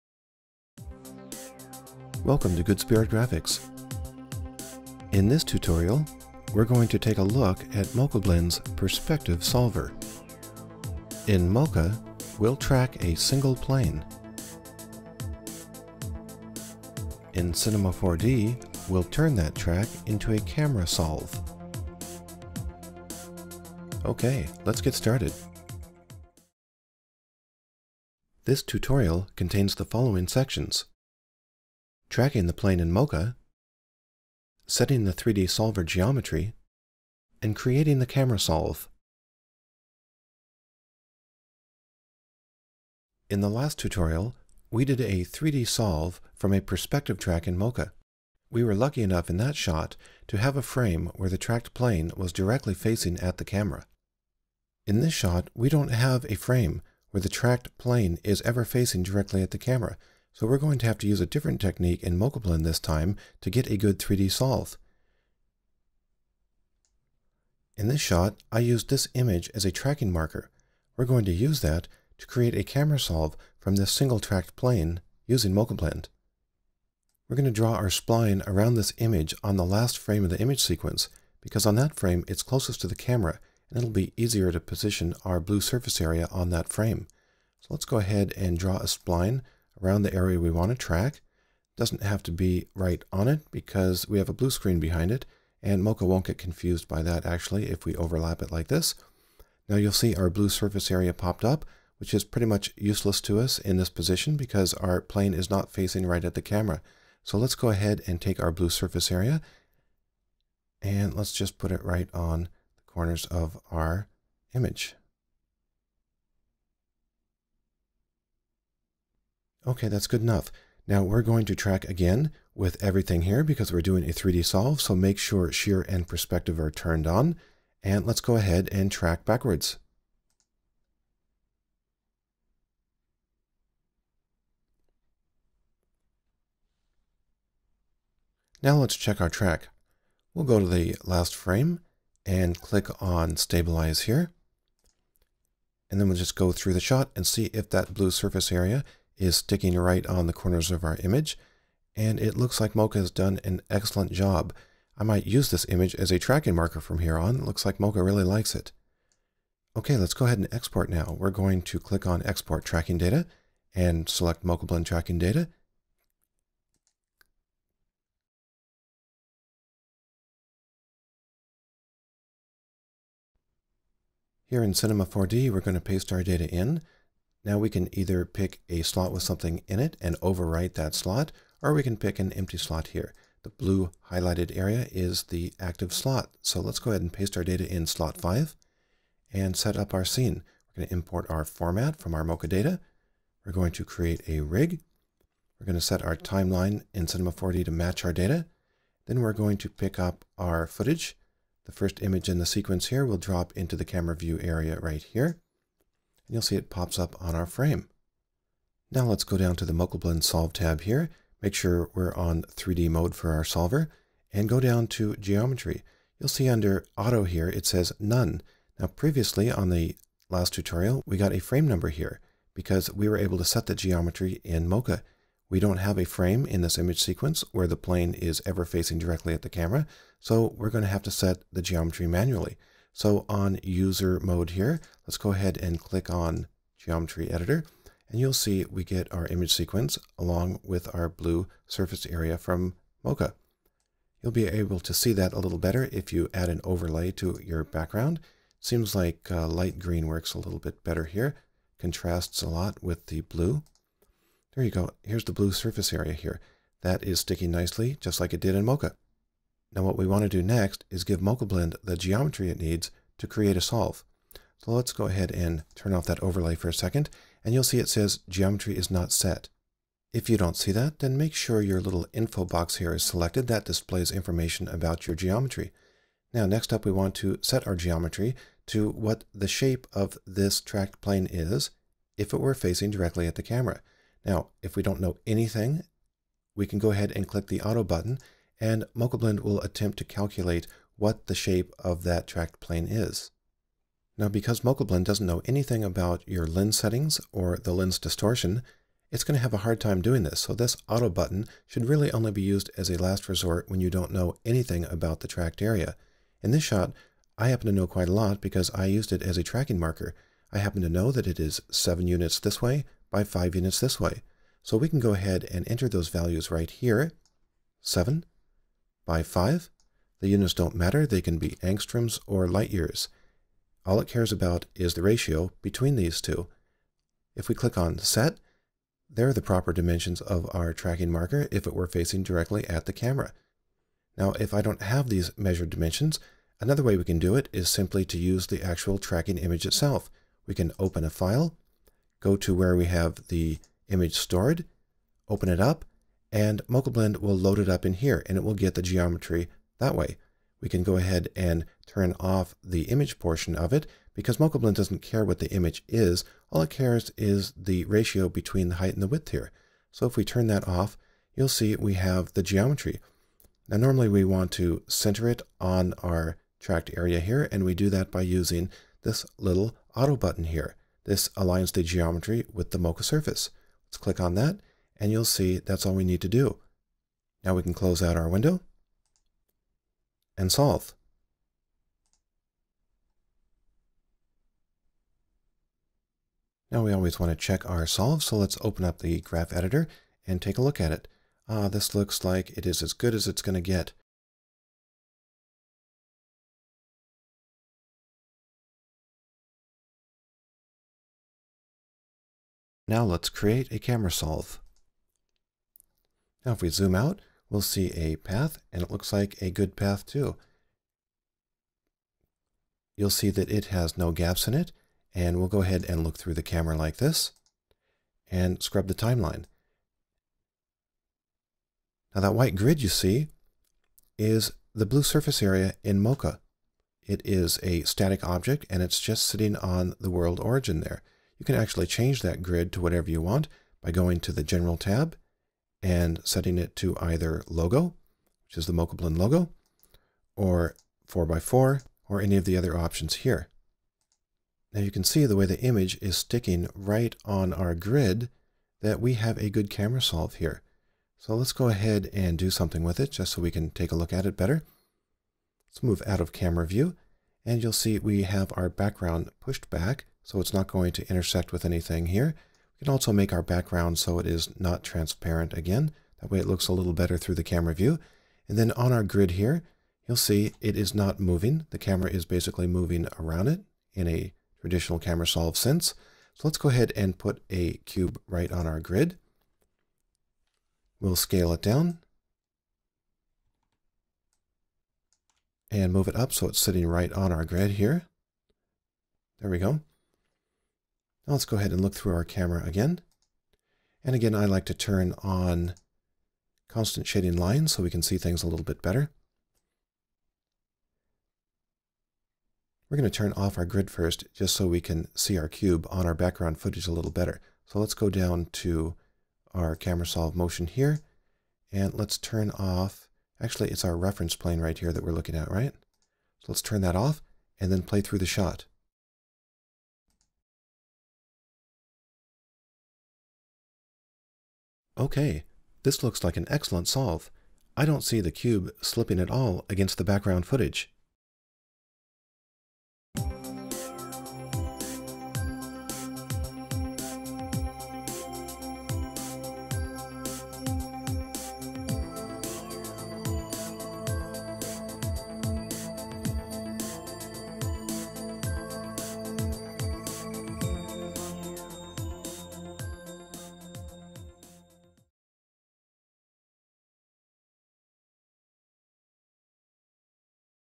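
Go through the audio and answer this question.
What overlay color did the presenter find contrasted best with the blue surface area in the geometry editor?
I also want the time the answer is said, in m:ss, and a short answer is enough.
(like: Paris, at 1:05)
Light green, at 4:09.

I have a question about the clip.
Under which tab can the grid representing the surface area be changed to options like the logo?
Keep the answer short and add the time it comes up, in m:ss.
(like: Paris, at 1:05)
General, at 7:14.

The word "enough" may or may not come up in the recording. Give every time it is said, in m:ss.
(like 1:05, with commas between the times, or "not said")
0:49, 2:00.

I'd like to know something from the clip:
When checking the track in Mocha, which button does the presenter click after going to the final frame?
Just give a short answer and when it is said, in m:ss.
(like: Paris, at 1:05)
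Stabilize, at 2:23.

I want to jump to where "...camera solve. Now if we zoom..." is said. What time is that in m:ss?
6:43.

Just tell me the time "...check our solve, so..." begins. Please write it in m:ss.
6:27.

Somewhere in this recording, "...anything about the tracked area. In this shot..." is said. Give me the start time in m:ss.
5:04.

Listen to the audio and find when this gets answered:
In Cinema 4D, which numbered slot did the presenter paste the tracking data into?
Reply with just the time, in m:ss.
3:07.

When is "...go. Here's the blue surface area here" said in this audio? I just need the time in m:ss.
4:14.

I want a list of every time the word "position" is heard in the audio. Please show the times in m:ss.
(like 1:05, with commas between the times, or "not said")
1:24, 1:43.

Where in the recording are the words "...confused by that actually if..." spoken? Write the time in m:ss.
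1:36.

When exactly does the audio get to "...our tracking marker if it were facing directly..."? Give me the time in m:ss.
5:30.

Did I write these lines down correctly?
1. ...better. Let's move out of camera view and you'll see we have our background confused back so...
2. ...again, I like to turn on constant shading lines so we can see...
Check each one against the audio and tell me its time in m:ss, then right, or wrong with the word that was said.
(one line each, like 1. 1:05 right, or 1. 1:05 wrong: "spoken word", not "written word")
1. 7:34 wrong: "pushed", not "confused"
2. 8:14 right.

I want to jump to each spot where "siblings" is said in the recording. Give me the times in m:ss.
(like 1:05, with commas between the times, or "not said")
not said.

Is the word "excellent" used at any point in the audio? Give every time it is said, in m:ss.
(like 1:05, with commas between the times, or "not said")
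2:33, 8:46.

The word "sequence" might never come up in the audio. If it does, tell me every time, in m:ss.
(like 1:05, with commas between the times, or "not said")
1:20, 3:22, 3:47, 3:59.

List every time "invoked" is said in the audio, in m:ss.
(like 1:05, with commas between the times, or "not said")
not said.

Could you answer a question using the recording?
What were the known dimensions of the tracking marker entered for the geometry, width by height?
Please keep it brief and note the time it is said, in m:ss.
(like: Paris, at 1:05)
7 by 5, at 5:17.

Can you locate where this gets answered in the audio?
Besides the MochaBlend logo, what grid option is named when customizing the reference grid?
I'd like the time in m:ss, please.
7:21.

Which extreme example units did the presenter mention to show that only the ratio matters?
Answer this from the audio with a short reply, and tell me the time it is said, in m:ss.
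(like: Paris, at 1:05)
Angstroms or light years, at 5:21.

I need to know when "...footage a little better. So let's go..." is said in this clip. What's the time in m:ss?
8:26.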